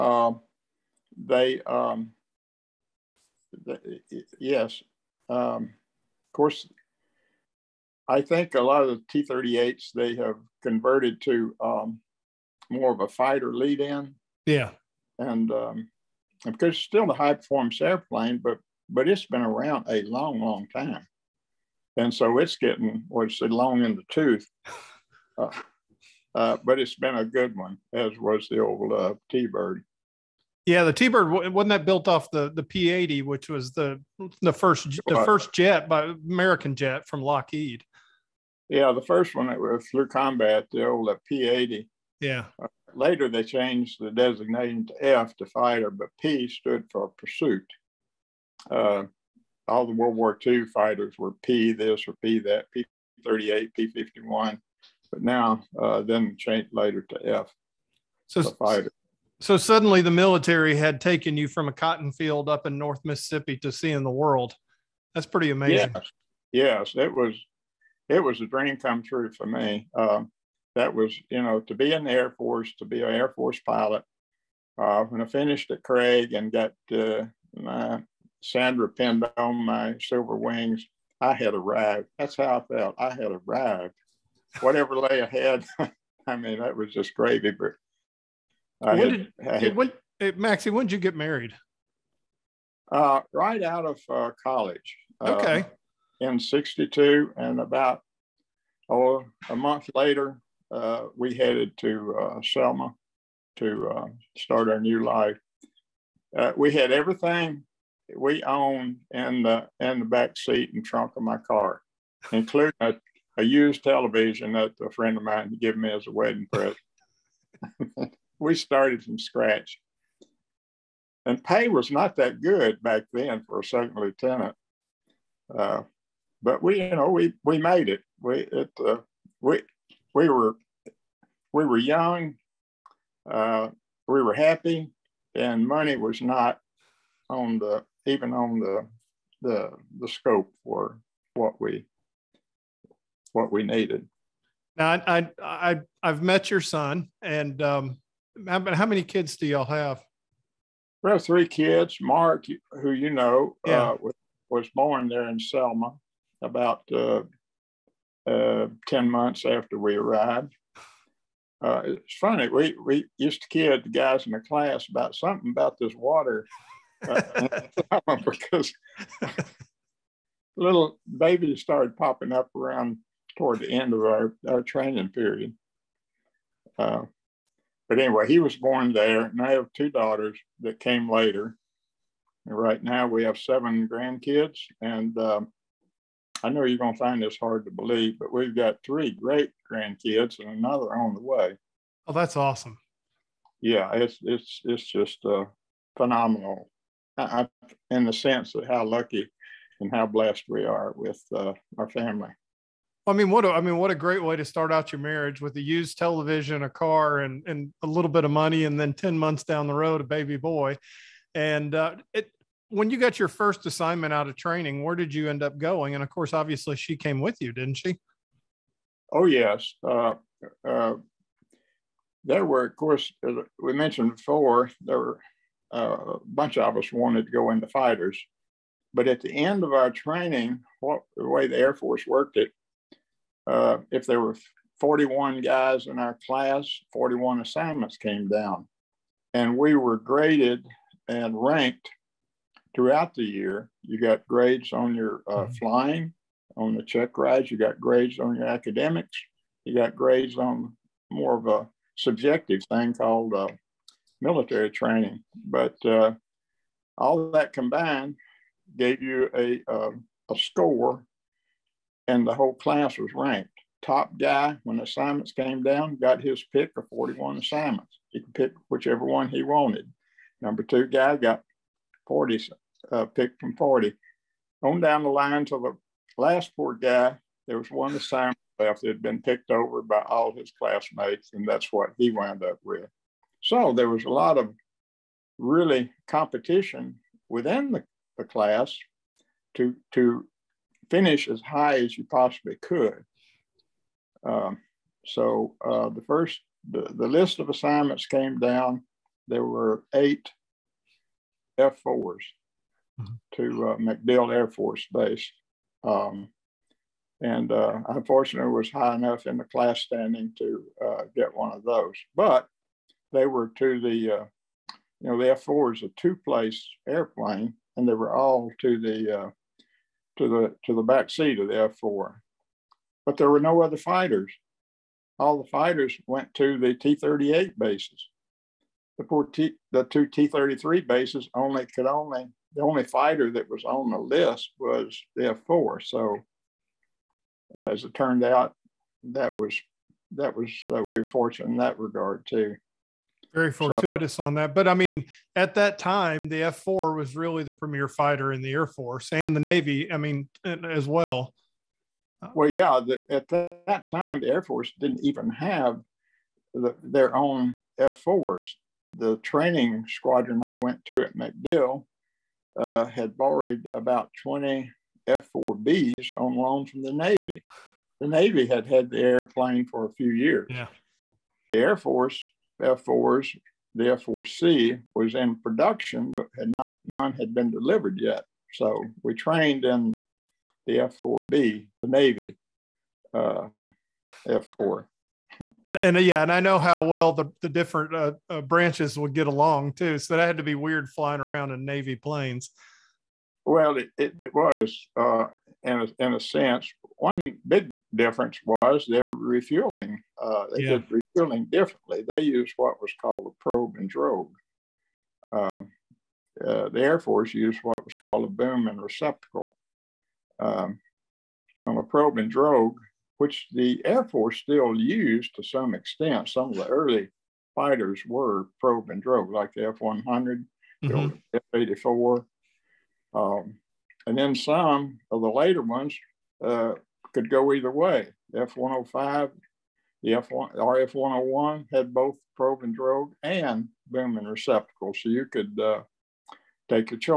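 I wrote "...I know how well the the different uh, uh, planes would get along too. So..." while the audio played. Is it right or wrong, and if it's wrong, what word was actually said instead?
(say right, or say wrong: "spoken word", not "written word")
wrong: "branches", not "planes".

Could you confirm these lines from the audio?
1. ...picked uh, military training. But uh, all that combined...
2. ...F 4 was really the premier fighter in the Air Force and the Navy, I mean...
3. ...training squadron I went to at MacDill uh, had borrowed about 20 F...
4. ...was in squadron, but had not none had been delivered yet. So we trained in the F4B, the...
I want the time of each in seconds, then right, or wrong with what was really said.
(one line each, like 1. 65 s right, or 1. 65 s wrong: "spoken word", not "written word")
1. 252 s wrong: "called", not "picked"
2. 346 s right
3. 359 s right
4. 374 s wrong: "production", not "squadron".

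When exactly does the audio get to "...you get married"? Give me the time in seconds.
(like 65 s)
90 s.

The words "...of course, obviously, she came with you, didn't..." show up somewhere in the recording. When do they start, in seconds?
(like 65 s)
216 s.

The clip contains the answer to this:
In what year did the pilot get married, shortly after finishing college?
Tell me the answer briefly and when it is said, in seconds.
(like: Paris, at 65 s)
1962, at 96 s.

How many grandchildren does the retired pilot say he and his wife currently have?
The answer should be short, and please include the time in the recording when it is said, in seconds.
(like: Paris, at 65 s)
7, at 183 s.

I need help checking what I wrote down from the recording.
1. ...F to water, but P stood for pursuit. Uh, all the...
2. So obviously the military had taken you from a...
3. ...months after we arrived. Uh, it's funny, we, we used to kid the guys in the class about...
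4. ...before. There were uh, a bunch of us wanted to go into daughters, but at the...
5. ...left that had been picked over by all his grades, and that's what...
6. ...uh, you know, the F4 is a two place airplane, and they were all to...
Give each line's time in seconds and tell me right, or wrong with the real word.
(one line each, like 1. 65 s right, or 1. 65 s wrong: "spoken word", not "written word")
1. 45 s wrong: "fighter", not "water"
2. 59 s wrong: "suddenly", not "obviously"
3. 159 s right
4. 224 s wrong: "fighters", not "daughters"
5. 278 s wrong: "classmates", not "grades"
6. 314 s right.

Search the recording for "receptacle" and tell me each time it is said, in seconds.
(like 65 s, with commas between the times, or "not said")
408 s, 434 s.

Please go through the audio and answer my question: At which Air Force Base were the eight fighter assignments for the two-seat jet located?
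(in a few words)
MacDill Air Force Base.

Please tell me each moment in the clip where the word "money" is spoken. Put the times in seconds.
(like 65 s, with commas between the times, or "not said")
135 s, 208 s.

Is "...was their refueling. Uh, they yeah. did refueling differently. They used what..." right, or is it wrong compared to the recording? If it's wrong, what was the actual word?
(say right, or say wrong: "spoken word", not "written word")
right.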